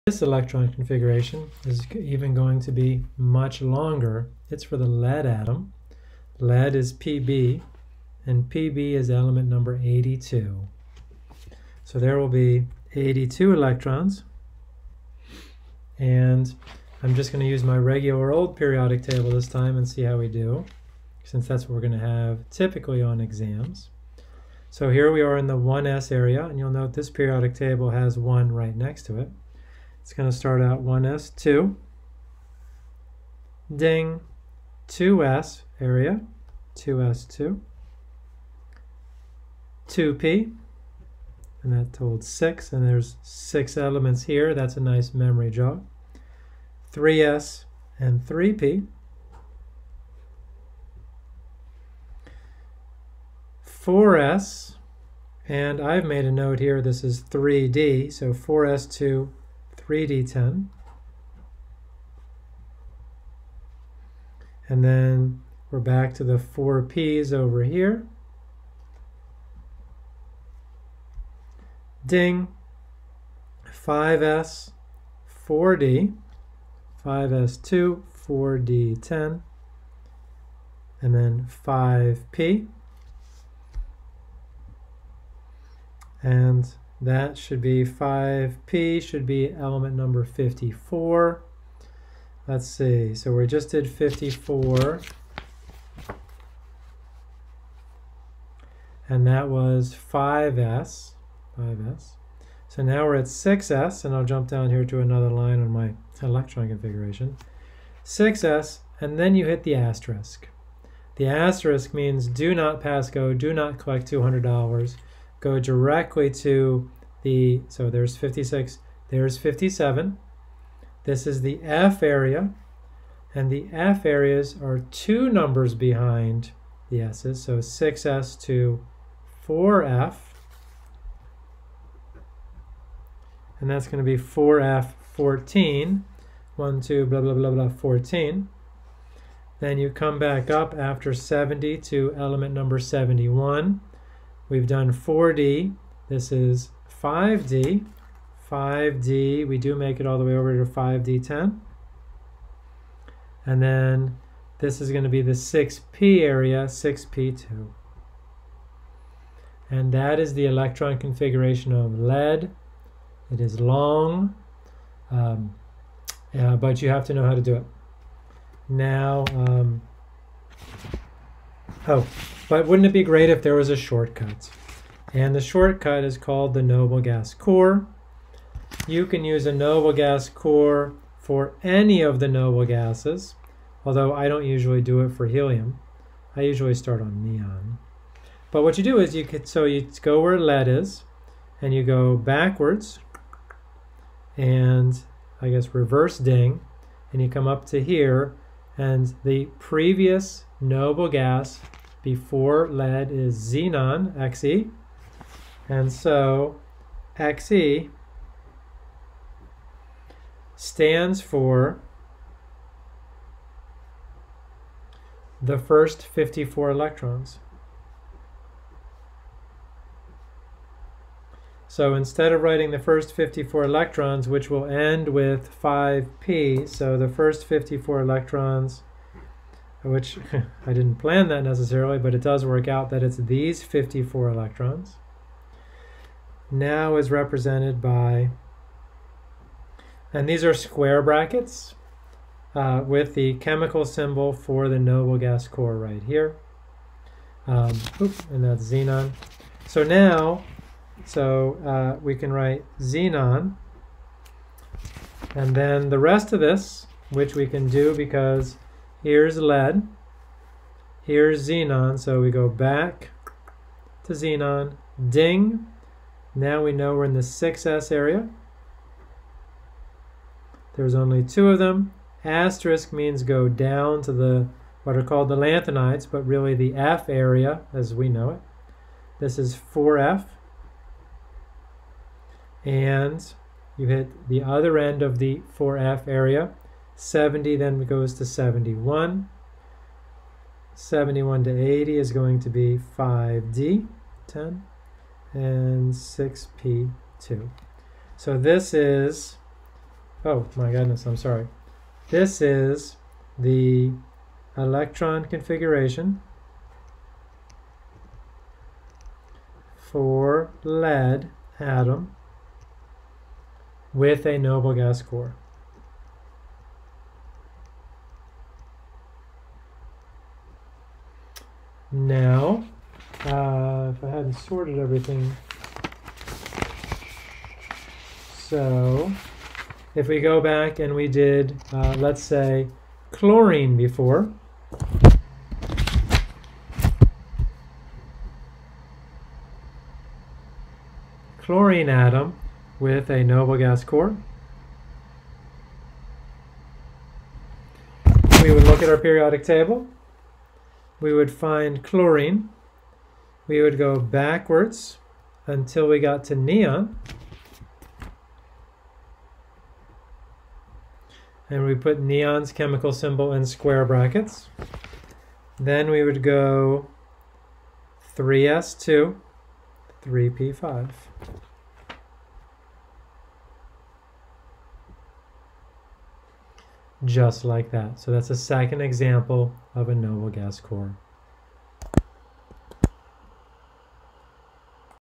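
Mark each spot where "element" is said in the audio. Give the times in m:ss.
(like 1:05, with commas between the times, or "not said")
0:09, 0:43, 1:29, 2:22.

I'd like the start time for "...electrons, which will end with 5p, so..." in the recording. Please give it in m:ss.
3:43.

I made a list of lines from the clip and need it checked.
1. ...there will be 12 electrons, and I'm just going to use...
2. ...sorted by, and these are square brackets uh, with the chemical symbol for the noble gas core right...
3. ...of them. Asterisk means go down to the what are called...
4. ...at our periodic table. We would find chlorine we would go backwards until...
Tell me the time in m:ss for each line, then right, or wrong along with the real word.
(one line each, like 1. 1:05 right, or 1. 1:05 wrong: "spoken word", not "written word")
1. 0:11 wrong: "82", not "12"
2. 3:57 wrong: "represented", not "sorted"
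3. 4:31 right
4. 5:48 right.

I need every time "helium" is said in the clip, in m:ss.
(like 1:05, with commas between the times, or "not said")
3:05.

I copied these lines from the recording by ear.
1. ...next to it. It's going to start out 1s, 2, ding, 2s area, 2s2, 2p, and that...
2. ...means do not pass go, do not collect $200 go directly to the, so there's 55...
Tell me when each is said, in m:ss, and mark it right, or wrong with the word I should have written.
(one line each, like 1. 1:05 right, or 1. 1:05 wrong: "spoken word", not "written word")
1. 0:28 right
2. 1:51 wrong: "56", not "55".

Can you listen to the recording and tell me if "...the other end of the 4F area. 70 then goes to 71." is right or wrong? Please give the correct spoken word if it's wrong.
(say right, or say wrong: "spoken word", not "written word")
right.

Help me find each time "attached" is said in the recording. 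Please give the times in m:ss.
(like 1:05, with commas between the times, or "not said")
not said.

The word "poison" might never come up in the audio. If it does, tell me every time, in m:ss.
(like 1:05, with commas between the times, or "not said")
not said.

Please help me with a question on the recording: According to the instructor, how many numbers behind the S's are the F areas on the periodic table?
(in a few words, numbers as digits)
2.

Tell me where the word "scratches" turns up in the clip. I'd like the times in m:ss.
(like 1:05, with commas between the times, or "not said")
not said.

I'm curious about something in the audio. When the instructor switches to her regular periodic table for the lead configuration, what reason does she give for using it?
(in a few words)
typically on exams.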